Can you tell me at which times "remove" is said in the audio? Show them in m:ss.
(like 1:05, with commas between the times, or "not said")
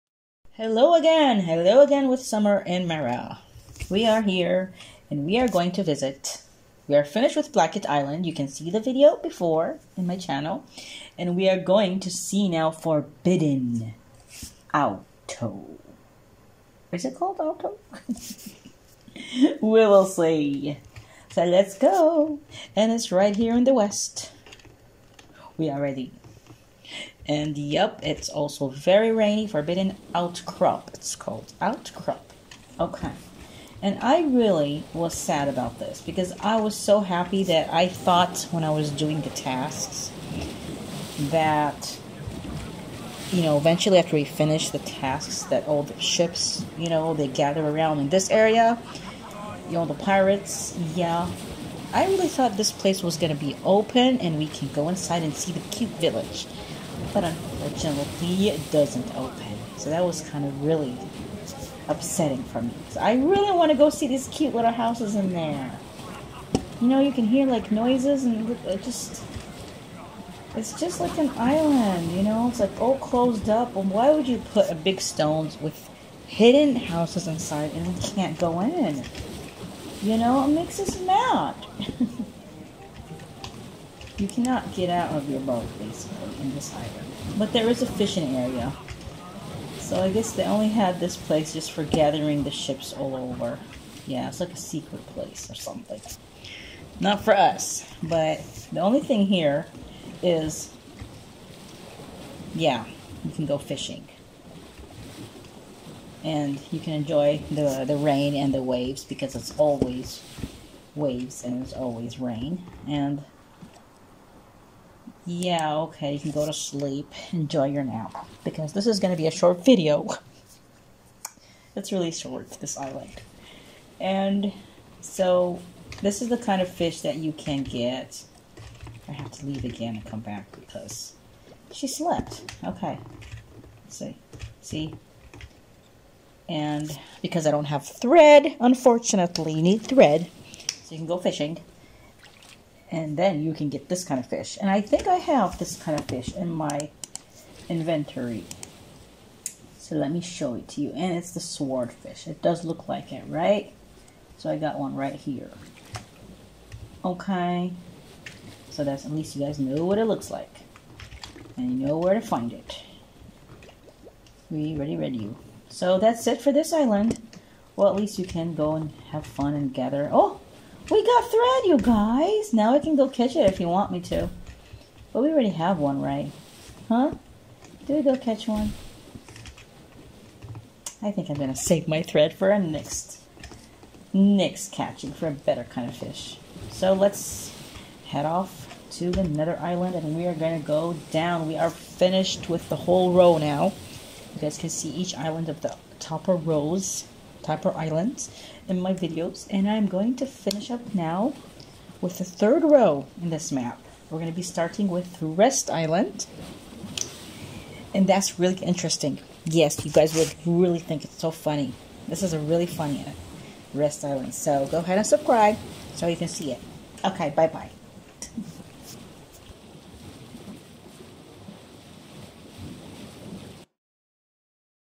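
not said.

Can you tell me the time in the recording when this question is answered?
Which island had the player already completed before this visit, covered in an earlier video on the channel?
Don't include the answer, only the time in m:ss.
0:07.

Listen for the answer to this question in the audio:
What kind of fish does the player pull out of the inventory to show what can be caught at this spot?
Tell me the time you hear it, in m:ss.
2:31.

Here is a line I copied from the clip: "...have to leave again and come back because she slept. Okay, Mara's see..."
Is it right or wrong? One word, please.
wrong.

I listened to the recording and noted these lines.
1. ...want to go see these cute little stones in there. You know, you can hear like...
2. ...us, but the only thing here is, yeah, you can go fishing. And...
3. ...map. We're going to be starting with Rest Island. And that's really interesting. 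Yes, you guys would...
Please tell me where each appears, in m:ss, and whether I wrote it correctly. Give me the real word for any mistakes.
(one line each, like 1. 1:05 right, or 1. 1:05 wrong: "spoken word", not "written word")
1. 1:03 wrong: "houses", not "stones"
2. 1:37 right
3. 3:23 right.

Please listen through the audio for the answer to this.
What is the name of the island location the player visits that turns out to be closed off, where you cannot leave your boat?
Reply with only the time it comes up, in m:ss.
0:29.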